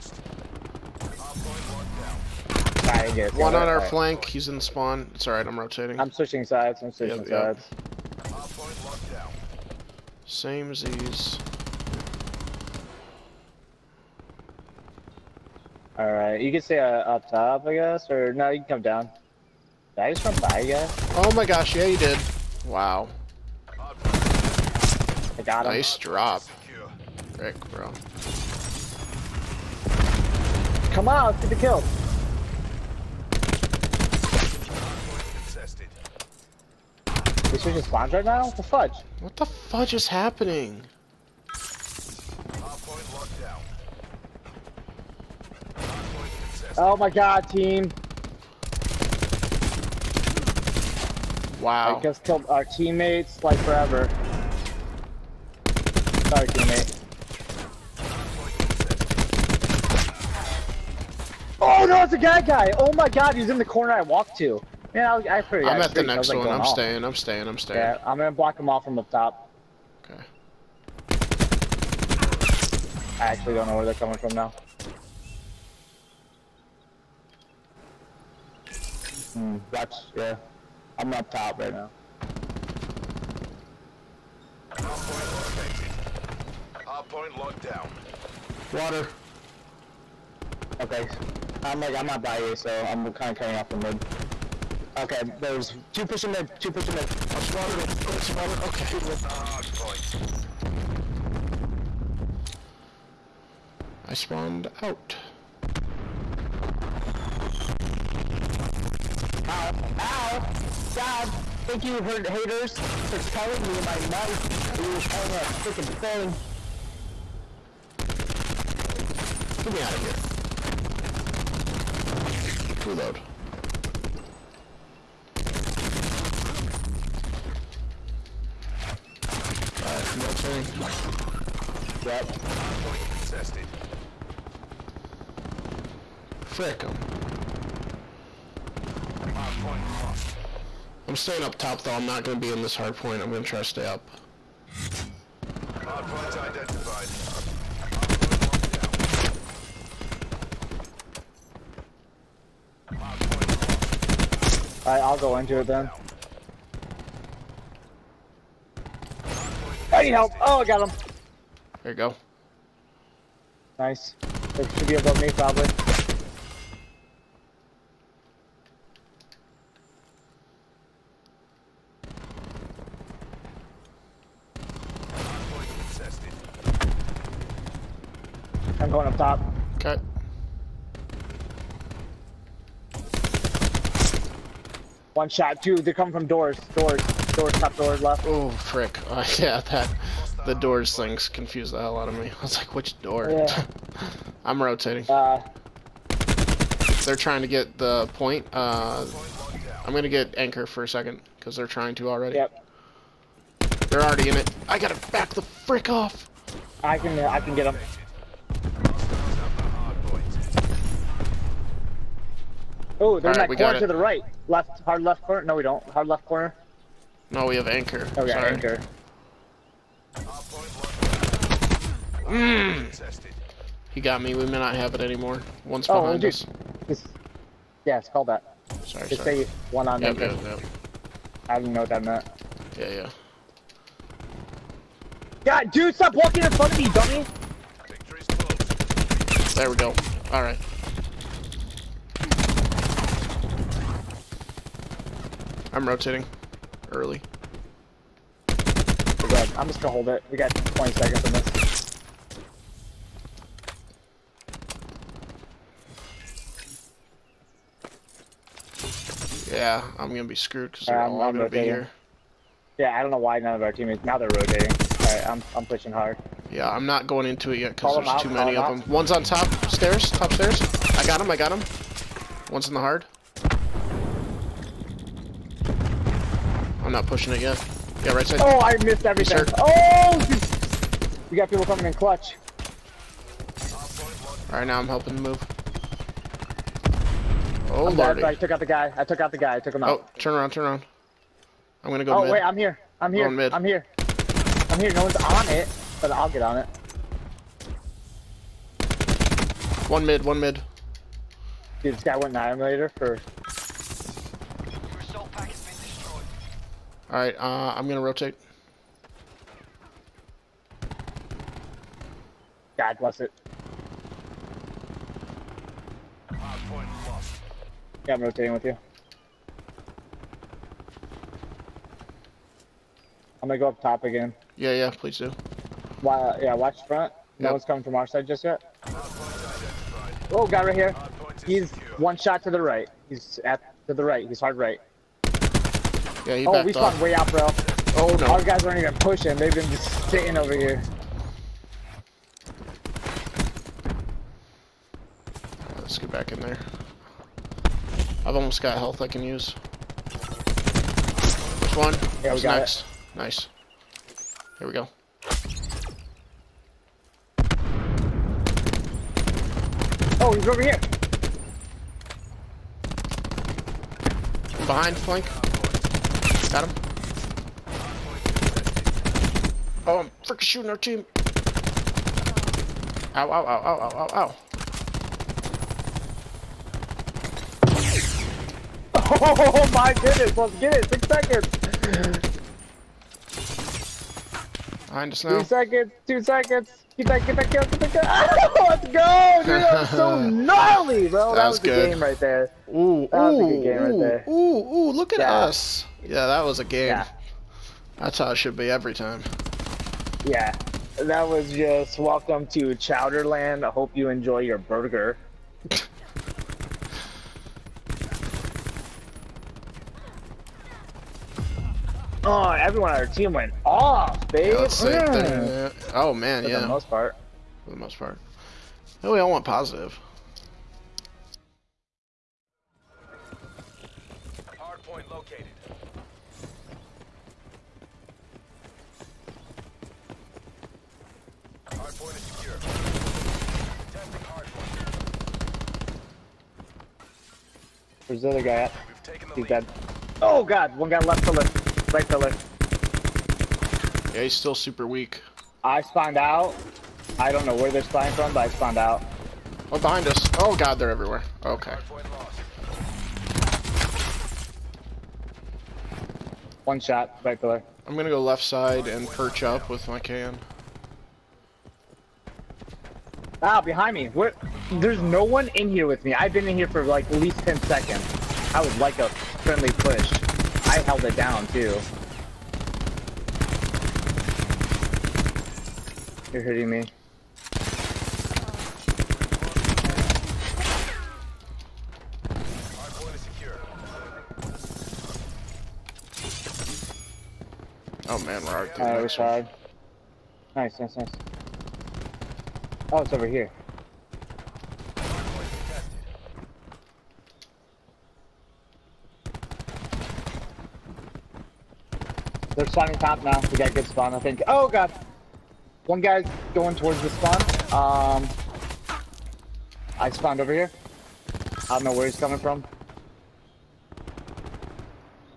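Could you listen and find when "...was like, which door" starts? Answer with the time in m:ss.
3:12.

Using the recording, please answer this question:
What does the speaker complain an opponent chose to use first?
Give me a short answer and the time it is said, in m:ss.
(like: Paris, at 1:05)
annihilator, at 5:02.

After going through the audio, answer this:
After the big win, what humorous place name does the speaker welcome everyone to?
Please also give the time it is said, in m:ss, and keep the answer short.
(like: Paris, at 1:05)
Chowderland, at 6:42.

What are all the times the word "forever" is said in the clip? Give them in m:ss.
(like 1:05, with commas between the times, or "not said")
0:53.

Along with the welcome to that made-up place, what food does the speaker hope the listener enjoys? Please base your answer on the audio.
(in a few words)
burger.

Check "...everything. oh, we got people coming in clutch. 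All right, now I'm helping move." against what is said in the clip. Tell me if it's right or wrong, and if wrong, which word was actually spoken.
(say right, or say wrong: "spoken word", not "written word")
right.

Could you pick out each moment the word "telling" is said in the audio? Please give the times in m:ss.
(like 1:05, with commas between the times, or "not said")
1:53.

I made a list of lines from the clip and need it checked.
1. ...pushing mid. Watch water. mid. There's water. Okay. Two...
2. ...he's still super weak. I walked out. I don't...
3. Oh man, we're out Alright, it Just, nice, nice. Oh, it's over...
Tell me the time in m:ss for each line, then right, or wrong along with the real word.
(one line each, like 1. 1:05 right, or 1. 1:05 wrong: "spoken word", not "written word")
1. 1:36 right
2. 7:24 wrong: "spawned", not "walked"
3. 8:08 wrong: "Nice", not "Just".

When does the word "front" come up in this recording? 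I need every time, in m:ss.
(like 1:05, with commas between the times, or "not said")
3:56, 5:26.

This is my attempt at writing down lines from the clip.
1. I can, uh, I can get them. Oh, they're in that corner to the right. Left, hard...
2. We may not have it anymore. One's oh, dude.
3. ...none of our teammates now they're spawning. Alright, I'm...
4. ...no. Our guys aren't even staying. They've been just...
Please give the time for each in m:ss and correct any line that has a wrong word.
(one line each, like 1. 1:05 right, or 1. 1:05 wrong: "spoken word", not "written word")
1. 3:26 right
2. 3:44 right
3. 4:23 wrong: "rotating", not "spawning"
4. 5:38 wrong: "pushing", not "staying".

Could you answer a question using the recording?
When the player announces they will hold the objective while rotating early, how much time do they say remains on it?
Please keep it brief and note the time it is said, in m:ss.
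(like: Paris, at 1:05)
20 seconds, at 4:10.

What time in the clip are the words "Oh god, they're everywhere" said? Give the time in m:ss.
7:30.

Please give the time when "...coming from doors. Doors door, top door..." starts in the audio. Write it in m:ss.
3:05.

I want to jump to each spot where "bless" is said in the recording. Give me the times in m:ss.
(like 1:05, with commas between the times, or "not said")
5:12.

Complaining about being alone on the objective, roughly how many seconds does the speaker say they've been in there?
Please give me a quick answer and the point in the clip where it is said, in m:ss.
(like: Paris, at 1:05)
10 seconds, at 7:47.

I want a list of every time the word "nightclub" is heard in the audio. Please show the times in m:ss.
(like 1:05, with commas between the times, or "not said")
not said.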